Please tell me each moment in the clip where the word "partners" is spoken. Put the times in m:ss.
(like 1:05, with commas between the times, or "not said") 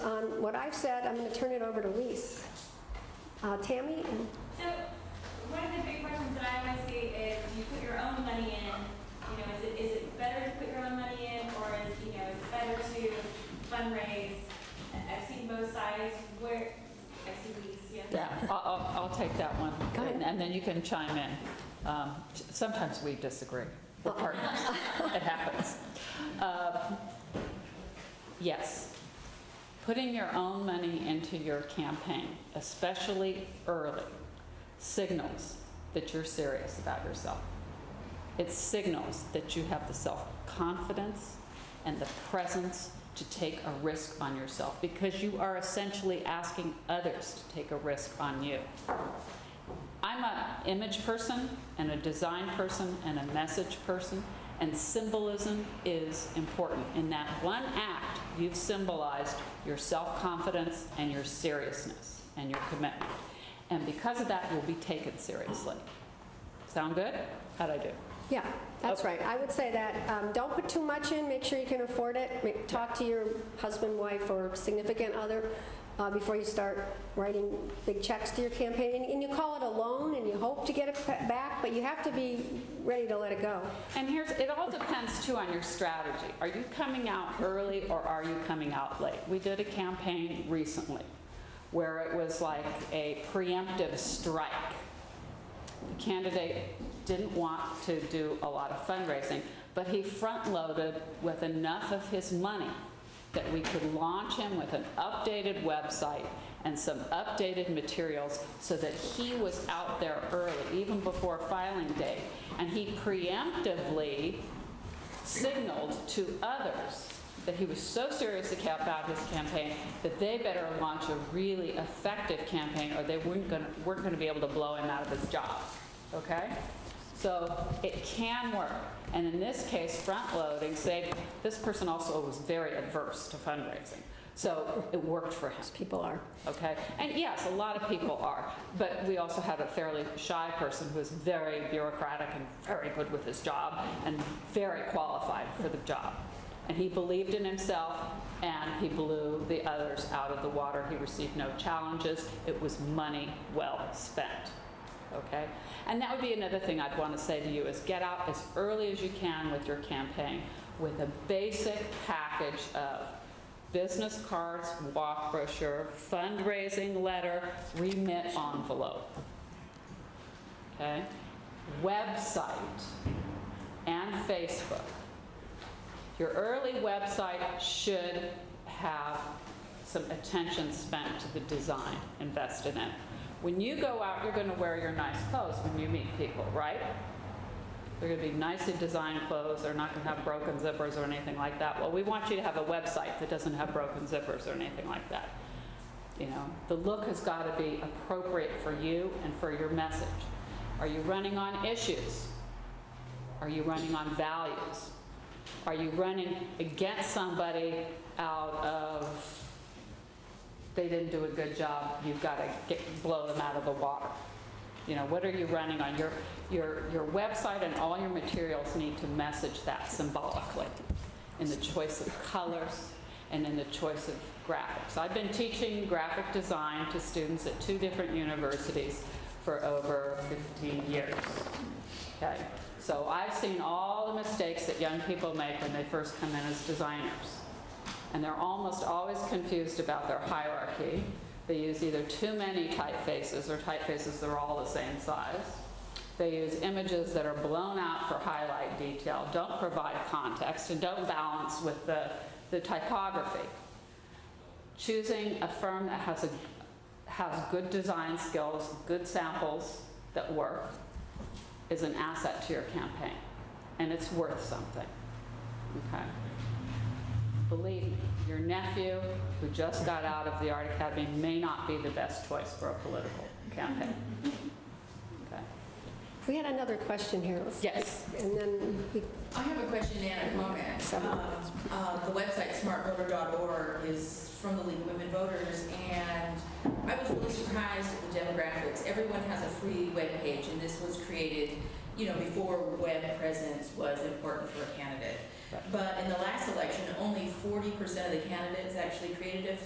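0:24.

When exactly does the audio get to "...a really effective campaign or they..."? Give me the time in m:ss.
2:01.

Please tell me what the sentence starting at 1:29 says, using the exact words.
We did a campaign recently where it was like a preemptive strike.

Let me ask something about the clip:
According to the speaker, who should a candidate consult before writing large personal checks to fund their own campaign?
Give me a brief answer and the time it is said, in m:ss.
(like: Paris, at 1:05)
husband, wife, or significant other, at 1:13.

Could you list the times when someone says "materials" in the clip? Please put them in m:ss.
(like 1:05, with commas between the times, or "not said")
1:47, 3:38.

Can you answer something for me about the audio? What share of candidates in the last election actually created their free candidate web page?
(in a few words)
40%.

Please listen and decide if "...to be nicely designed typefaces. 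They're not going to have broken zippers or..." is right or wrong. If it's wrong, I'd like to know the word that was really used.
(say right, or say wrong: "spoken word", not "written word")
wrong: "clothes", not "typefaces".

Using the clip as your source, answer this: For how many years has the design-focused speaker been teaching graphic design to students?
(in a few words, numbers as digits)
over 15 years.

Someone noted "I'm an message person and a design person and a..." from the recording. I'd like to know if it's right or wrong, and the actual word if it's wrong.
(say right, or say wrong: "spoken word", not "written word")
wrong: "image", not "message".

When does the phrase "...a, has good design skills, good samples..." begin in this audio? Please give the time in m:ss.
4:16.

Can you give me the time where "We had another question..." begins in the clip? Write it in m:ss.
4:36.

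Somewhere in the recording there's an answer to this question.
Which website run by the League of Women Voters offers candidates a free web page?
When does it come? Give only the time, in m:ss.
4:42.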